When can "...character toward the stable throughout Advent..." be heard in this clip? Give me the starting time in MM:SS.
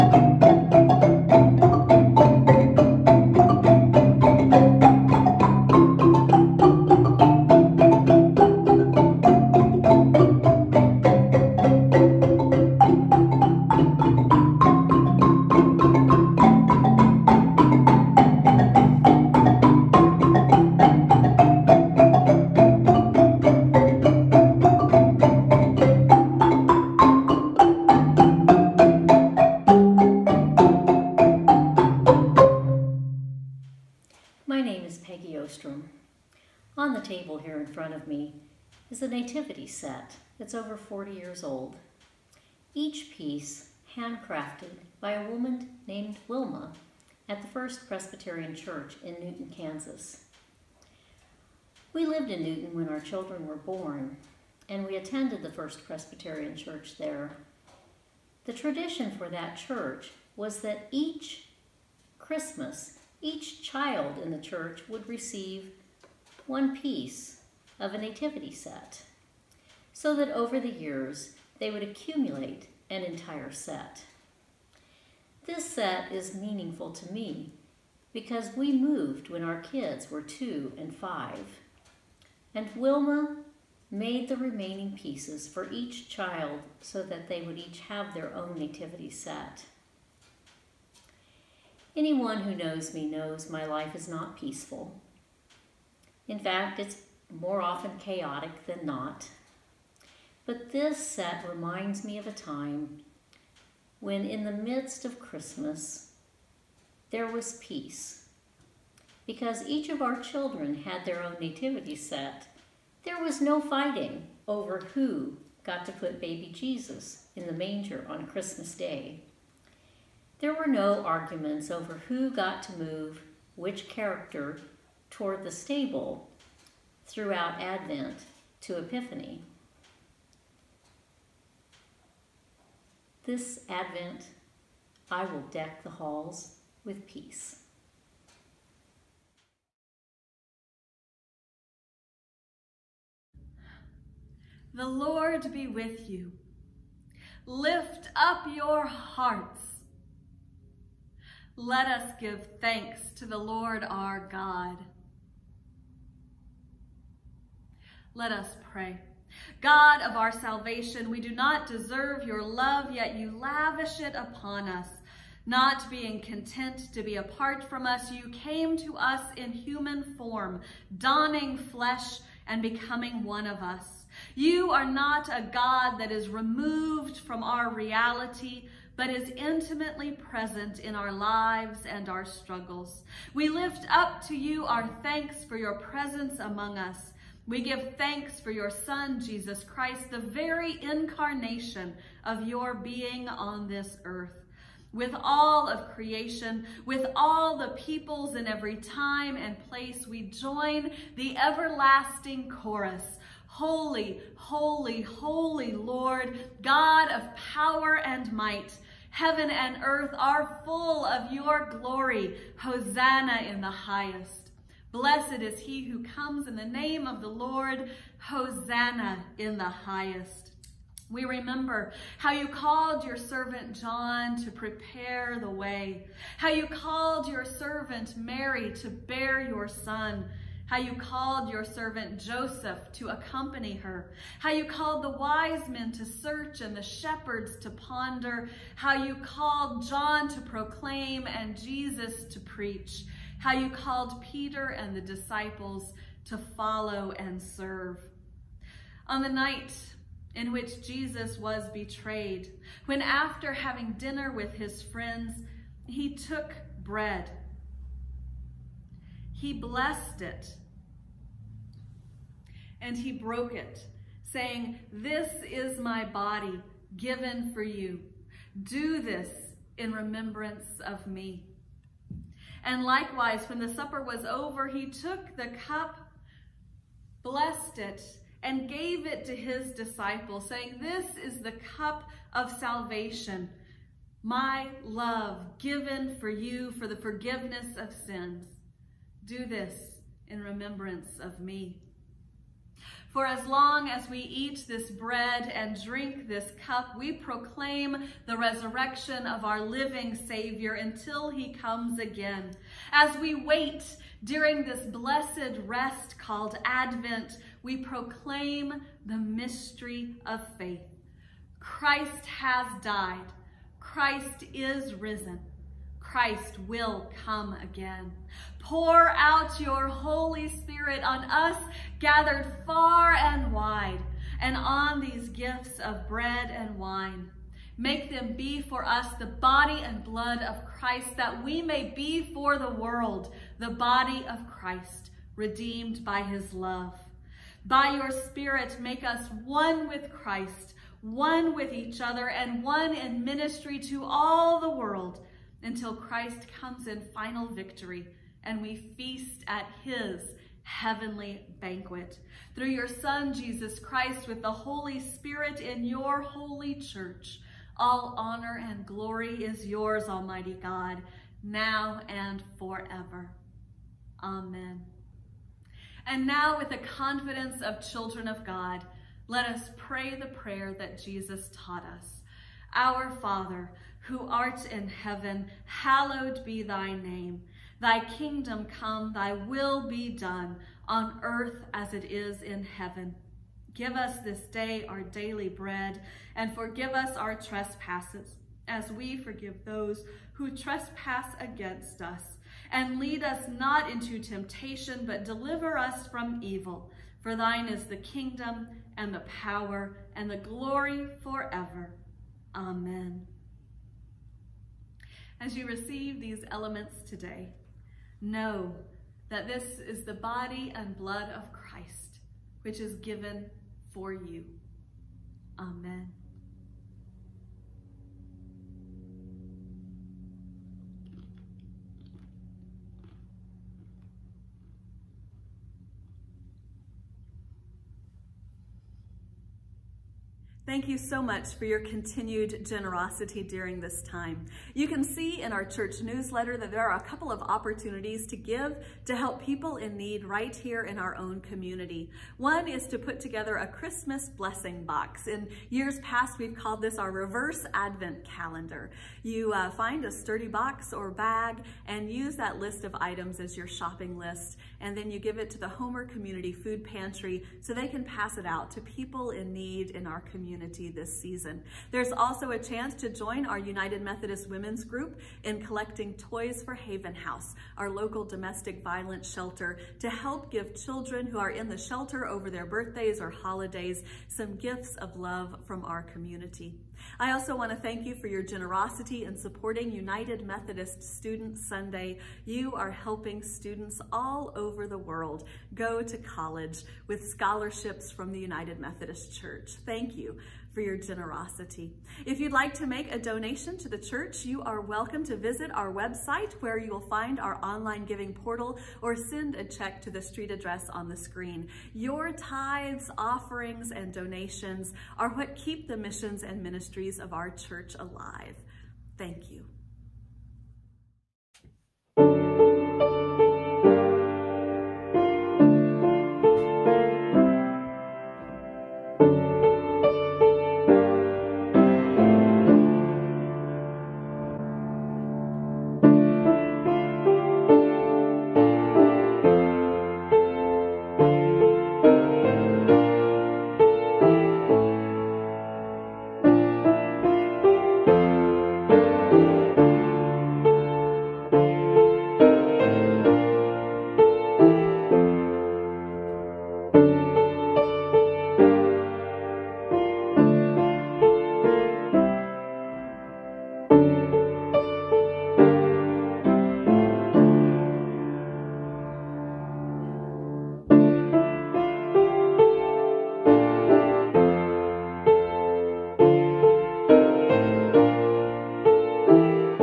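02:03.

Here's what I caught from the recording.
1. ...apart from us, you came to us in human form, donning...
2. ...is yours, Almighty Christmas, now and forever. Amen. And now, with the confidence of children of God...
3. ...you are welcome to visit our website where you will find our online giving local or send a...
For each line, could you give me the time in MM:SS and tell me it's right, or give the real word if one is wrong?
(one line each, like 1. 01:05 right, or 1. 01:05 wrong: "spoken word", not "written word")
1. 02:47 right
2. 05:59 wrong: "God", not "Christmas"
3. 08:14 wrong: "portal", not "local".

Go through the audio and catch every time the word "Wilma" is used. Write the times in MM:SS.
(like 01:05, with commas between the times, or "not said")
00:46, 01:22.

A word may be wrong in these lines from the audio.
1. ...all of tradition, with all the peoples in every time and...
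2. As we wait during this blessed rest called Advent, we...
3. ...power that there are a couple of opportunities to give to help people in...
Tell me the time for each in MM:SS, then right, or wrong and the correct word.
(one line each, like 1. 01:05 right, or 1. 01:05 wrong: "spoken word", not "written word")
1. 03:15 wrong: "creation", not "tradition"
2. 05:02 right
3. 07:16 wrong: "newsletter", not "power".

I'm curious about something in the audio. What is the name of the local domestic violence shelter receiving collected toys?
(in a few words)
Haven House.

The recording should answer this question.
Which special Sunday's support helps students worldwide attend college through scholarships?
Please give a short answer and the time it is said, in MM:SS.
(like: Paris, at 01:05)
United Methodist Student Sunday, at 07:59.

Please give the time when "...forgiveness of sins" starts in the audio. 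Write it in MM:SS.
04:46.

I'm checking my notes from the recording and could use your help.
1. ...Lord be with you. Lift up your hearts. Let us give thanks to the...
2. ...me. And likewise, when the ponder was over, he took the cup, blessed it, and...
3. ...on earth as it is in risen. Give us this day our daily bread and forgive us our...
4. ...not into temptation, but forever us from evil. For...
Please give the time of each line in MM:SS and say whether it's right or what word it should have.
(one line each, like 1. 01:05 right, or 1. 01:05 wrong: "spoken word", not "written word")
1. 02:24 right
2. 04:31 wrong: "supper", not "ponder"
3. 06:20 wrong: "heaven", not "risen"
4. 06:33 wrong: "deliver", not "forever".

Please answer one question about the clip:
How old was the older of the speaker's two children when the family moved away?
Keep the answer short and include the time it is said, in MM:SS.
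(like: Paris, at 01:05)
5, at 01:20.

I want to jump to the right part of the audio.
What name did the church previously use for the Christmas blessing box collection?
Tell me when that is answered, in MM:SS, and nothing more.
07:27.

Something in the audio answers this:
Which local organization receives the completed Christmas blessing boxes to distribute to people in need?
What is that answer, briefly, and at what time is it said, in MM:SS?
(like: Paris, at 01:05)
Homer Community Food Pantry, at 07:35.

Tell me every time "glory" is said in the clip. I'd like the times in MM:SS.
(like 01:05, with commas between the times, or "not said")
03:31, 05:58, 06:40.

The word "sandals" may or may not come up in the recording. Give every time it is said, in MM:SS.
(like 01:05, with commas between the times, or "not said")
not said.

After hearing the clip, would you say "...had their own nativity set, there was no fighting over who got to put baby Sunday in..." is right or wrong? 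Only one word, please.
wrong.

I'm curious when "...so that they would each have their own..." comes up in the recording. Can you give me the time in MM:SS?
01:26.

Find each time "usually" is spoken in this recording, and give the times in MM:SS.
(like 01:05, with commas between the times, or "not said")
not said.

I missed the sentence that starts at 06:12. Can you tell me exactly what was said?
Our Father, who art in heaven, hallowed be thy name.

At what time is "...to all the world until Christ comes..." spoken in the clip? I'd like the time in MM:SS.
05:43.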